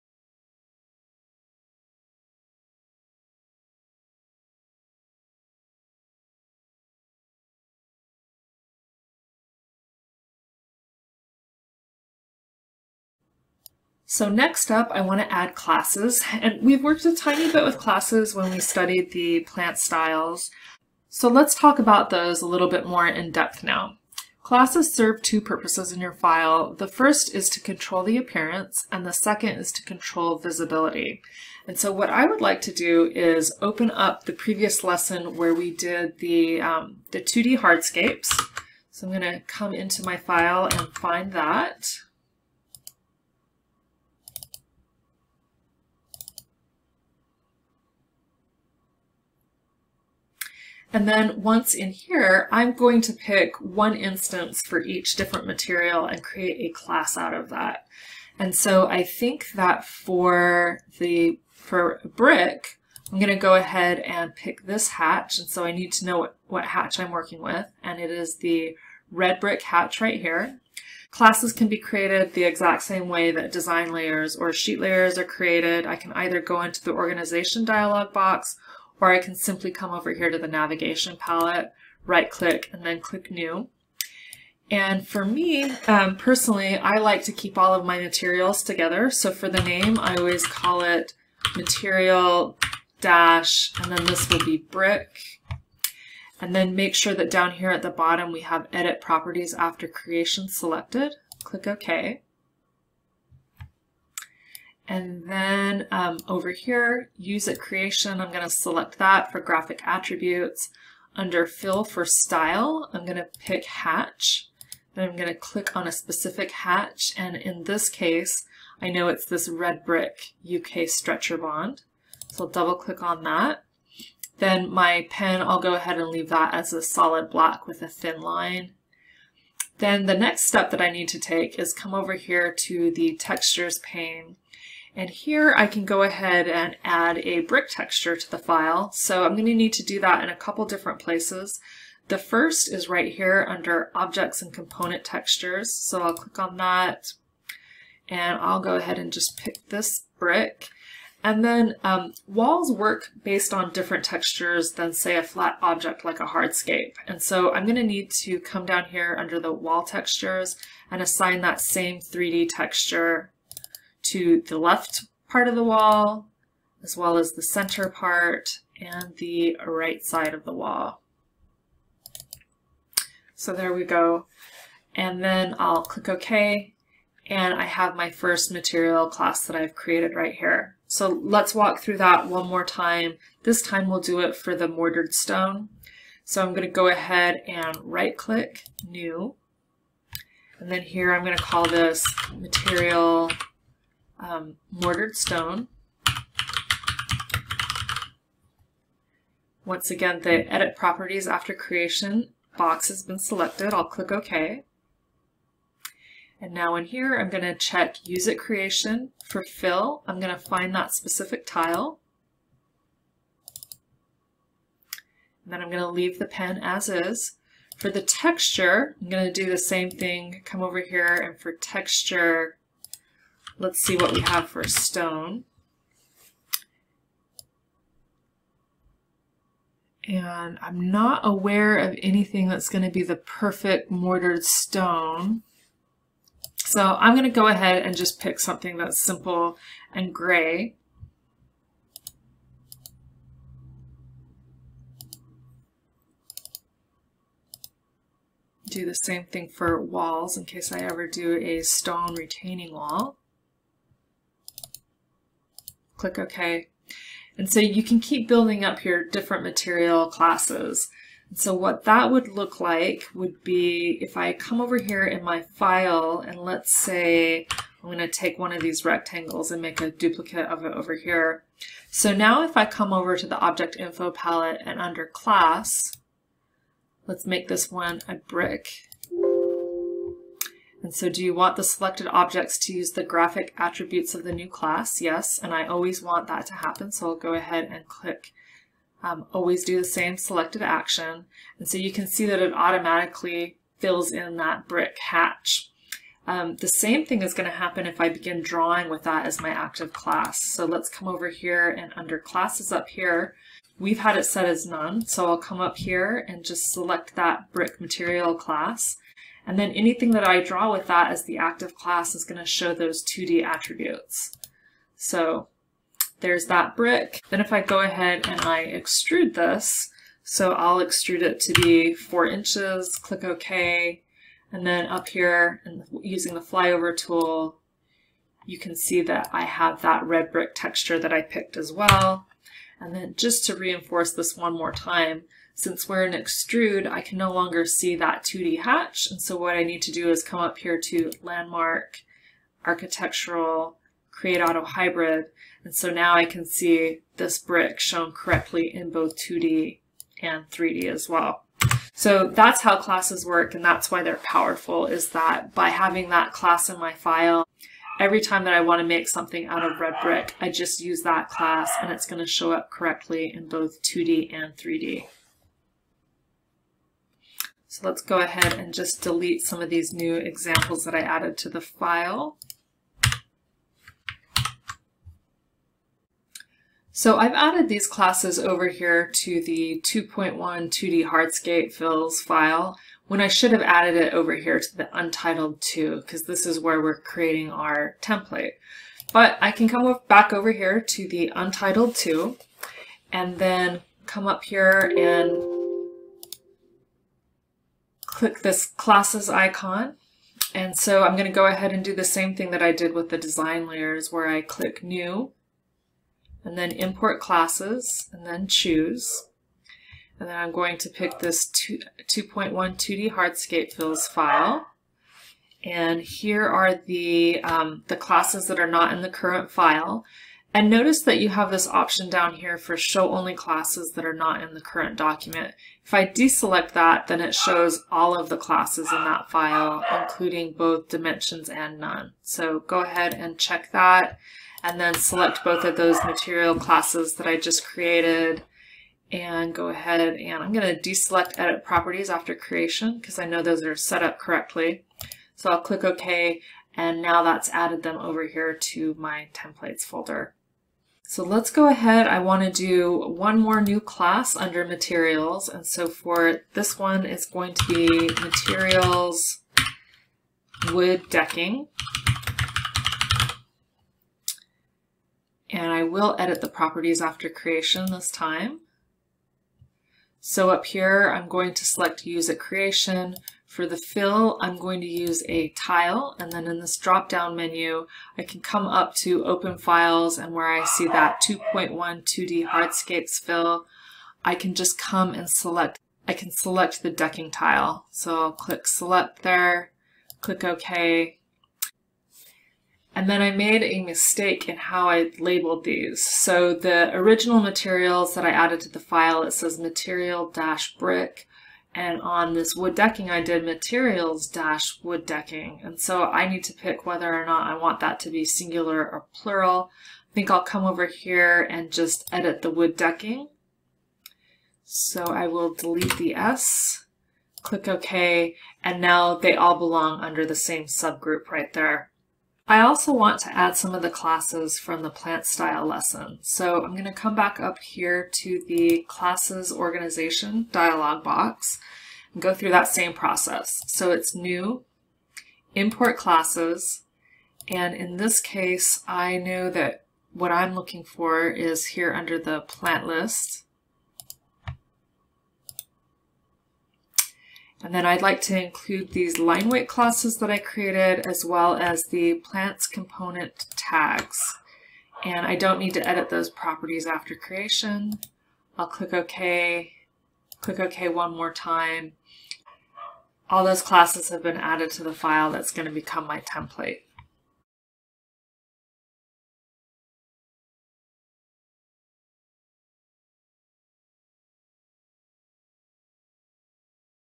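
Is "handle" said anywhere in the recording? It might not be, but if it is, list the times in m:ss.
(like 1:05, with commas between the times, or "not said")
not said.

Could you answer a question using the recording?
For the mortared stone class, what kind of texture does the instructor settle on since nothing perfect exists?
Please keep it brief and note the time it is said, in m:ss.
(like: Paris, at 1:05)
simple and gray, at 3:59.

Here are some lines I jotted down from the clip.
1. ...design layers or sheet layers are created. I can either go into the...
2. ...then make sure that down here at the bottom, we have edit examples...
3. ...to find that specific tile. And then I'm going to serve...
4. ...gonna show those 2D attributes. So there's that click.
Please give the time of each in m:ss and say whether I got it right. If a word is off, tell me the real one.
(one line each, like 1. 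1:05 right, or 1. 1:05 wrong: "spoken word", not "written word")
1. 1:13 right
2. 1:36 wrong: "properties", not "examples"
3. 3:30 wrong: "leave", not "serve"
4. 5:12 wrong: "brick", not "click".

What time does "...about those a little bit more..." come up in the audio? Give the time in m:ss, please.
0:21.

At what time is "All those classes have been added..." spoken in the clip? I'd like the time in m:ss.
9:23.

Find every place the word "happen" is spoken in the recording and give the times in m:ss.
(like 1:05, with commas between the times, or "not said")
4:46, 4:57.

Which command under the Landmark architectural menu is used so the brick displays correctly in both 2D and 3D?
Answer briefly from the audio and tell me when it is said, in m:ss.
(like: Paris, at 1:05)
create auto hybrid, at 5:44.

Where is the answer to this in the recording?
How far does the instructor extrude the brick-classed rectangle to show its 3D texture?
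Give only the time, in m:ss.
5:21.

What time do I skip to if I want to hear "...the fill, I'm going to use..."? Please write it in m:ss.
7:53.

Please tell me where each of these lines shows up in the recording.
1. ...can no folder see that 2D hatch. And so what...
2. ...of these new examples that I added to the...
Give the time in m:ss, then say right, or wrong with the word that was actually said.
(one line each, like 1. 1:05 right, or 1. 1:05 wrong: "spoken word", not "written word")
1. 5:37 wrong: "longer", not "folder"
2. 6:09 right.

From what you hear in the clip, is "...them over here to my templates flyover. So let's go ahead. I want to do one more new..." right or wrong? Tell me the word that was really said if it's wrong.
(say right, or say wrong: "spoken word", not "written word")
wrong: "folder", not "flyover".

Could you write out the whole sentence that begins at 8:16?
So the original materials that I added to the file, it says material-brick.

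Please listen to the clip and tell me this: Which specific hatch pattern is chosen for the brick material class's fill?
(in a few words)
red brick UK stretcher bond.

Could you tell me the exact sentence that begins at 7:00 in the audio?
And notice that you have this option down here for show only classes that are not in the current document.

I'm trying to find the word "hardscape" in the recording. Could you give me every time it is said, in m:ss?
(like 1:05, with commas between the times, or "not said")
0:37, 2:36, 6:21, 6:53, 8:02.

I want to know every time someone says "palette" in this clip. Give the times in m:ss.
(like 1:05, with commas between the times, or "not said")
1:21, 4:34.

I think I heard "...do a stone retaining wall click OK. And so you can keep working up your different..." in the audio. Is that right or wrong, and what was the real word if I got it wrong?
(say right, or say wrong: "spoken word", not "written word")
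wrong: "building", not "working".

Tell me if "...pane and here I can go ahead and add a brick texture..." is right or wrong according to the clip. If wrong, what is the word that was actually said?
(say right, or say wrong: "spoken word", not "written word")
right.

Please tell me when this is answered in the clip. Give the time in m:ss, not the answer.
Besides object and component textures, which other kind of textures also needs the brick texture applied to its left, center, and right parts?
2:39.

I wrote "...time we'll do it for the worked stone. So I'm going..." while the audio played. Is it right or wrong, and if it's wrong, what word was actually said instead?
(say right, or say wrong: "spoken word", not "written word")
wrong: "mortared", not "worked".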